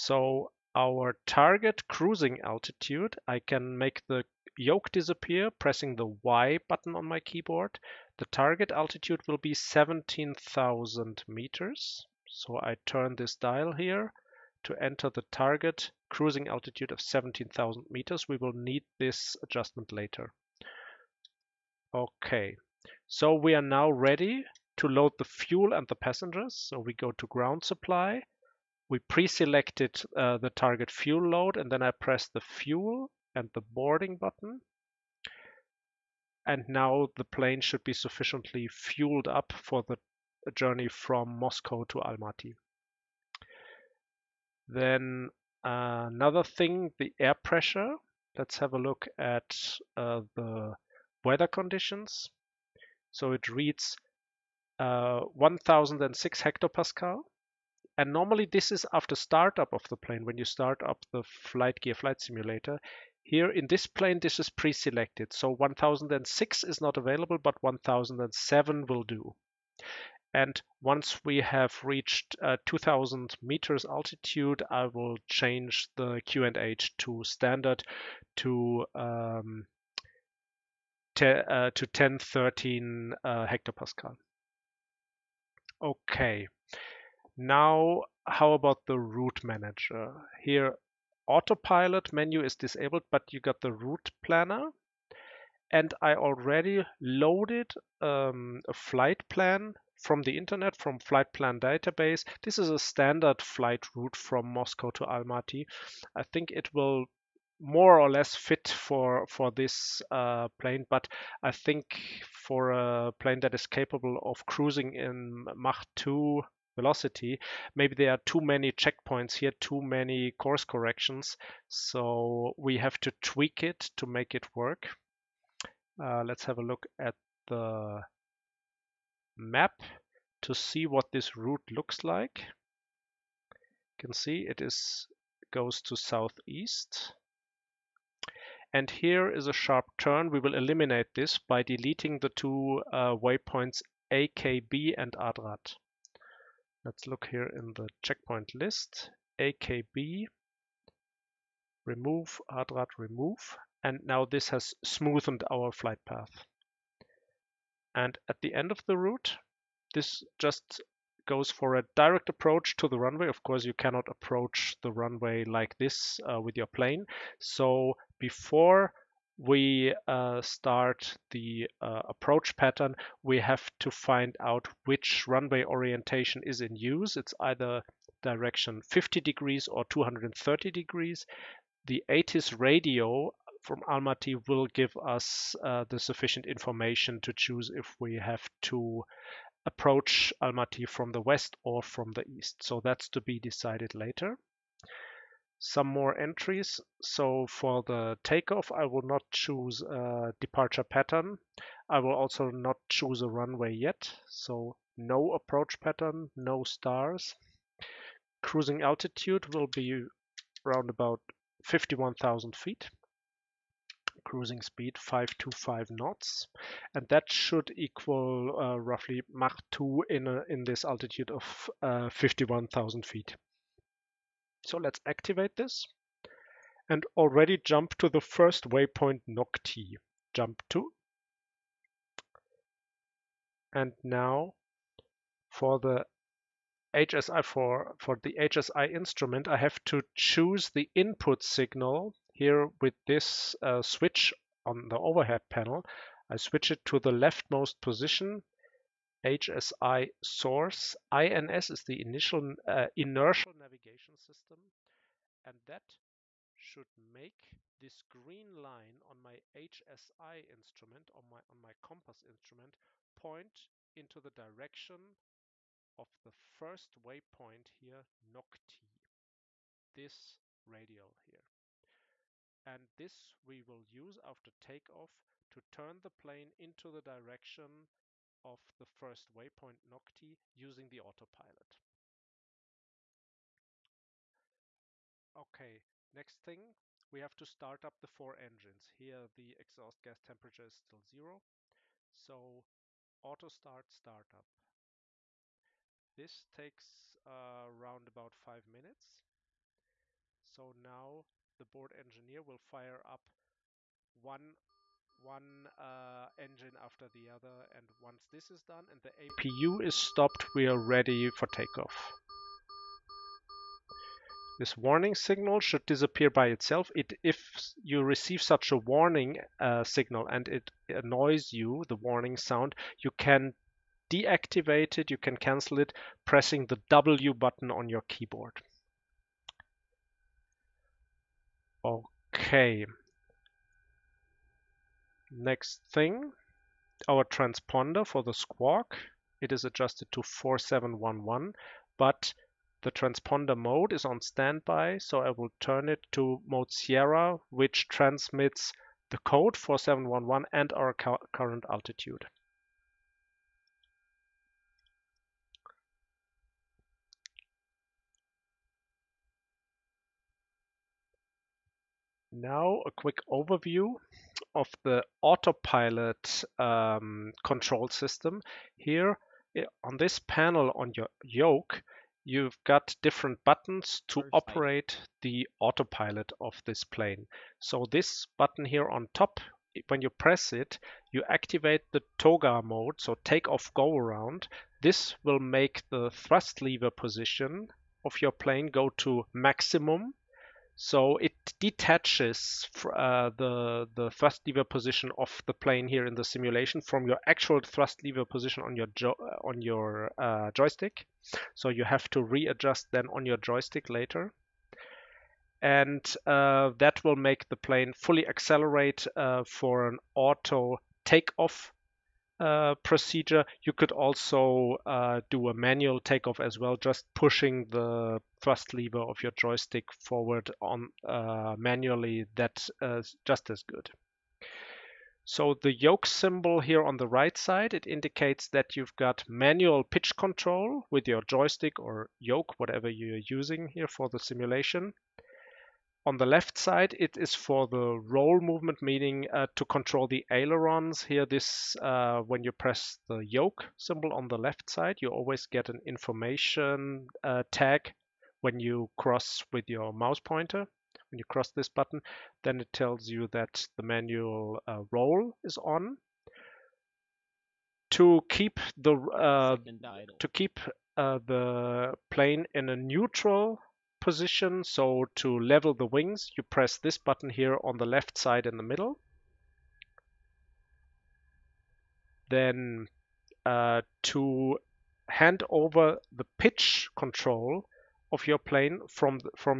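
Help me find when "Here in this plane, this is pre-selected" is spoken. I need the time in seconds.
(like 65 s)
63 s.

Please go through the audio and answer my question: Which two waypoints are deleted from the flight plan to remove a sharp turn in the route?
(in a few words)
AKB and ADRAT.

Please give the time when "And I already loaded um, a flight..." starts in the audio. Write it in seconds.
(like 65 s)
95 s.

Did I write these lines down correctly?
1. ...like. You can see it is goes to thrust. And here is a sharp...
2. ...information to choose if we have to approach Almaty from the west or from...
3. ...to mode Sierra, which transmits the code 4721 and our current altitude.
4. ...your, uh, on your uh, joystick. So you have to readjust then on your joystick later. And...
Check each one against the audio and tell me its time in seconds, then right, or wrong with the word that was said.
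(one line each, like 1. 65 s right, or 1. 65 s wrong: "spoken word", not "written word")
1. 132 s wrong: "southeast", not "thrust"
2. 186 s right
3. 346 s wrong: "4711", not "4721"
4. 398 s right.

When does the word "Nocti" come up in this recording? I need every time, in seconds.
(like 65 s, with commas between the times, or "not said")
229 s, 268 s, 279 s.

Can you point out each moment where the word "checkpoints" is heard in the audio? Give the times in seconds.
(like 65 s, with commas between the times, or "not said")
118 s, 148 s.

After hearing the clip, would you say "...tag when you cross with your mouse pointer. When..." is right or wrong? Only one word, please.
right.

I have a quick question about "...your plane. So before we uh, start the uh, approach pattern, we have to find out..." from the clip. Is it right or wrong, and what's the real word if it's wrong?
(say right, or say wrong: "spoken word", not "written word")
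right.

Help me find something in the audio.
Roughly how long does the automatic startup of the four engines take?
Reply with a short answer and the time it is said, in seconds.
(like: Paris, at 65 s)
5 minutes, at 298 s.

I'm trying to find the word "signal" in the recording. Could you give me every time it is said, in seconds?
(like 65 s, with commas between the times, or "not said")
241 s, 315 s, 319 s.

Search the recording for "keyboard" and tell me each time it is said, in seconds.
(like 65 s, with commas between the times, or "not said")
7 s, 328 s.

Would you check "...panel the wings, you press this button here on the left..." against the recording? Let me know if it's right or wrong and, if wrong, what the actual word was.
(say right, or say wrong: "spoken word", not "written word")
wrong: "level", not "panel".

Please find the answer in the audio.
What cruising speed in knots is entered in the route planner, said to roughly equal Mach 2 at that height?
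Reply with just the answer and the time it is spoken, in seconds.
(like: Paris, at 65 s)
525 knots, at 214 s.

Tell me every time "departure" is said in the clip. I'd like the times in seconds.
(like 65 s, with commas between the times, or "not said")
200 s.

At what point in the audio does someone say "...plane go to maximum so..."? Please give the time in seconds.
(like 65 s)
388 s.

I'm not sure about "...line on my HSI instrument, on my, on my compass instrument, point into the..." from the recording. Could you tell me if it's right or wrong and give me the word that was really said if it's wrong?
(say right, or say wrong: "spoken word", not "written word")
right.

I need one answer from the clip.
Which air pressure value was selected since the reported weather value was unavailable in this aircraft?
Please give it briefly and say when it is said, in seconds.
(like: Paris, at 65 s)
1007, at 67 s.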